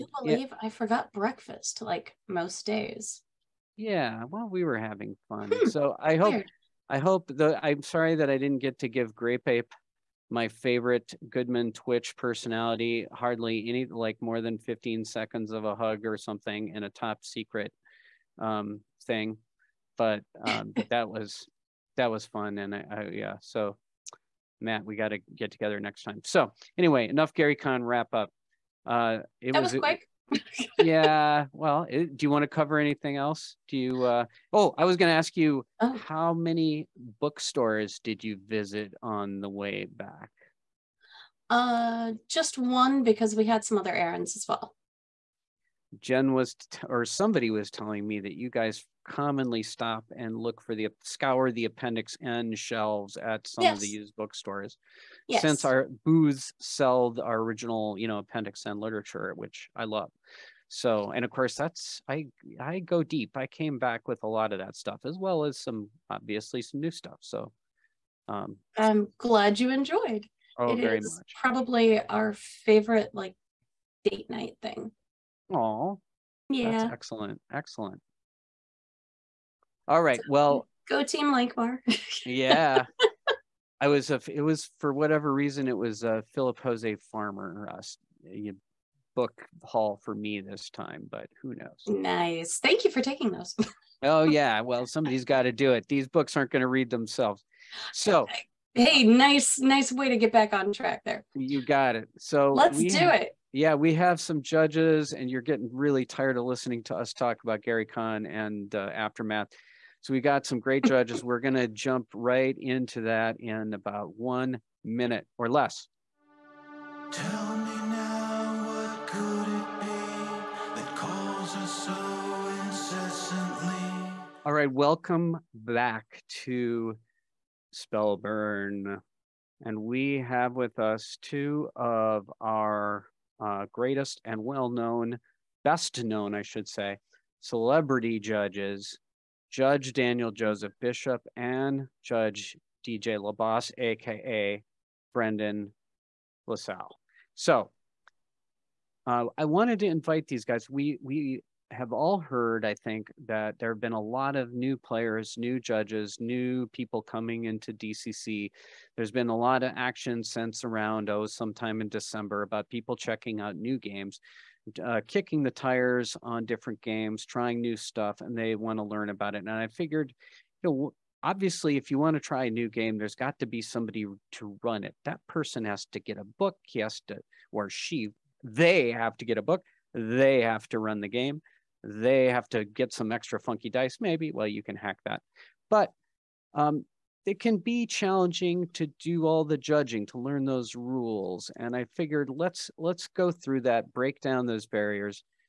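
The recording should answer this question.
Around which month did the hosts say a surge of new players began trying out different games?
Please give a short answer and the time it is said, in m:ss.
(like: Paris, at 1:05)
December, at 2:41.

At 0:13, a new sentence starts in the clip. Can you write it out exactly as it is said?
Hardly any, like more than 15 seconds of a hug or something, in a top secret um, thing.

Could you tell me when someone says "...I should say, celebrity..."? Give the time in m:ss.
2:16.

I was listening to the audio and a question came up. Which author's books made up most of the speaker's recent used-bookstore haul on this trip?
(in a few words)
Philip Jose Farmer.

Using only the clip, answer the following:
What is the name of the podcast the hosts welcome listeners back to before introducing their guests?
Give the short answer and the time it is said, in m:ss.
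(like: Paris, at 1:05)
Spellburn, at 2:07.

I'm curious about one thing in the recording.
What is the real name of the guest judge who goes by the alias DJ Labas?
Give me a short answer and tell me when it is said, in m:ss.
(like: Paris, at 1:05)
Brendan LaSalle, at 2:25.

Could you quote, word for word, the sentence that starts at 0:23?
So Matt, we got to get together next time.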